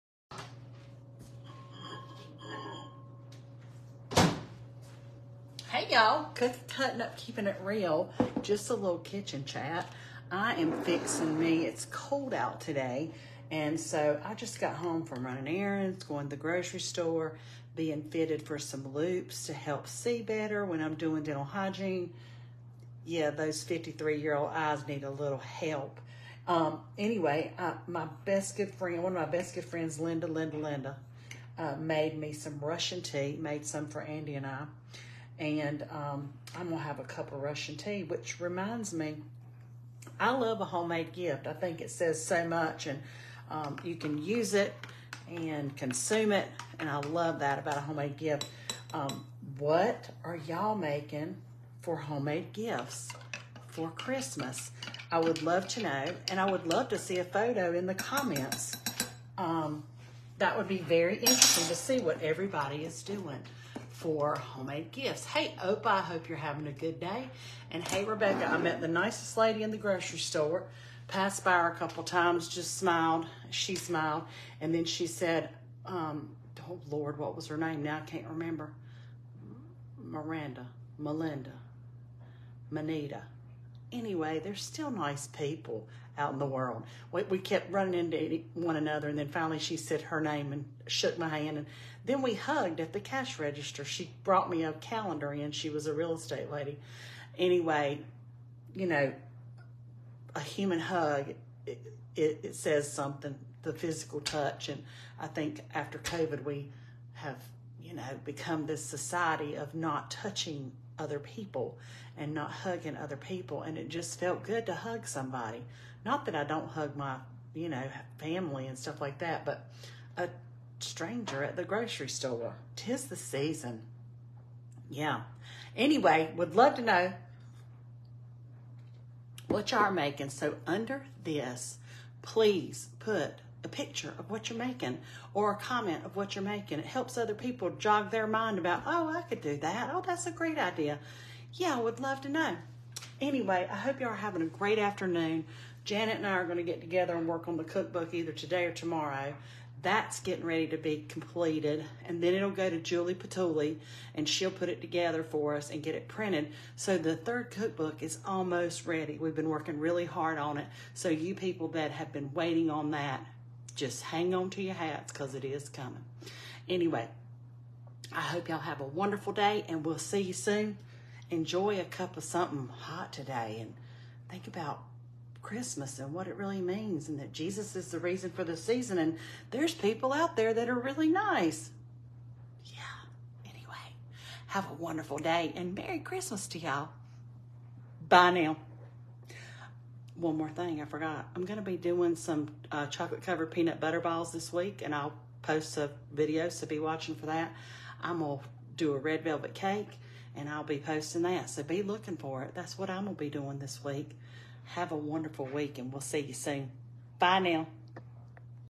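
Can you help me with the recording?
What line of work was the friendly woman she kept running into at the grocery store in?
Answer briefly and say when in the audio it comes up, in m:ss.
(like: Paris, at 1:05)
real estate, at 1:35.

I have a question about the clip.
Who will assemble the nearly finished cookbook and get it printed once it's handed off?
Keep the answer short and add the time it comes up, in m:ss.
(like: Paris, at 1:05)
Julie Patuli, at 2:32.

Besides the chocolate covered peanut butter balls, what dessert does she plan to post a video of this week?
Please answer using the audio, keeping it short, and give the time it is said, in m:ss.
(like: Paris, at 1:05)
red velvet cake, at 3:18.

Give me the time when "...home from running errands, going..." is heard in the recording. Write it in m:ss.
0:14.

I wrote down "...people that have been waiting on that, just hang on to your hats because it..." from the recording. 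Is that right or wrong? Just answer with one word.
right.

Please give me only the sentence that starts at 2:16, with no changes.
It helps other people jog their mind about, oh, I could do that.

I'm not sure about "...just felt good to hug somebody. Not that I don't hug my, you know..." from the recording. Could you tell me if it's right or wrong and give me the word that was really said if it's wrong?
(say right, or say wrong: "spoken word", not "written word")
right.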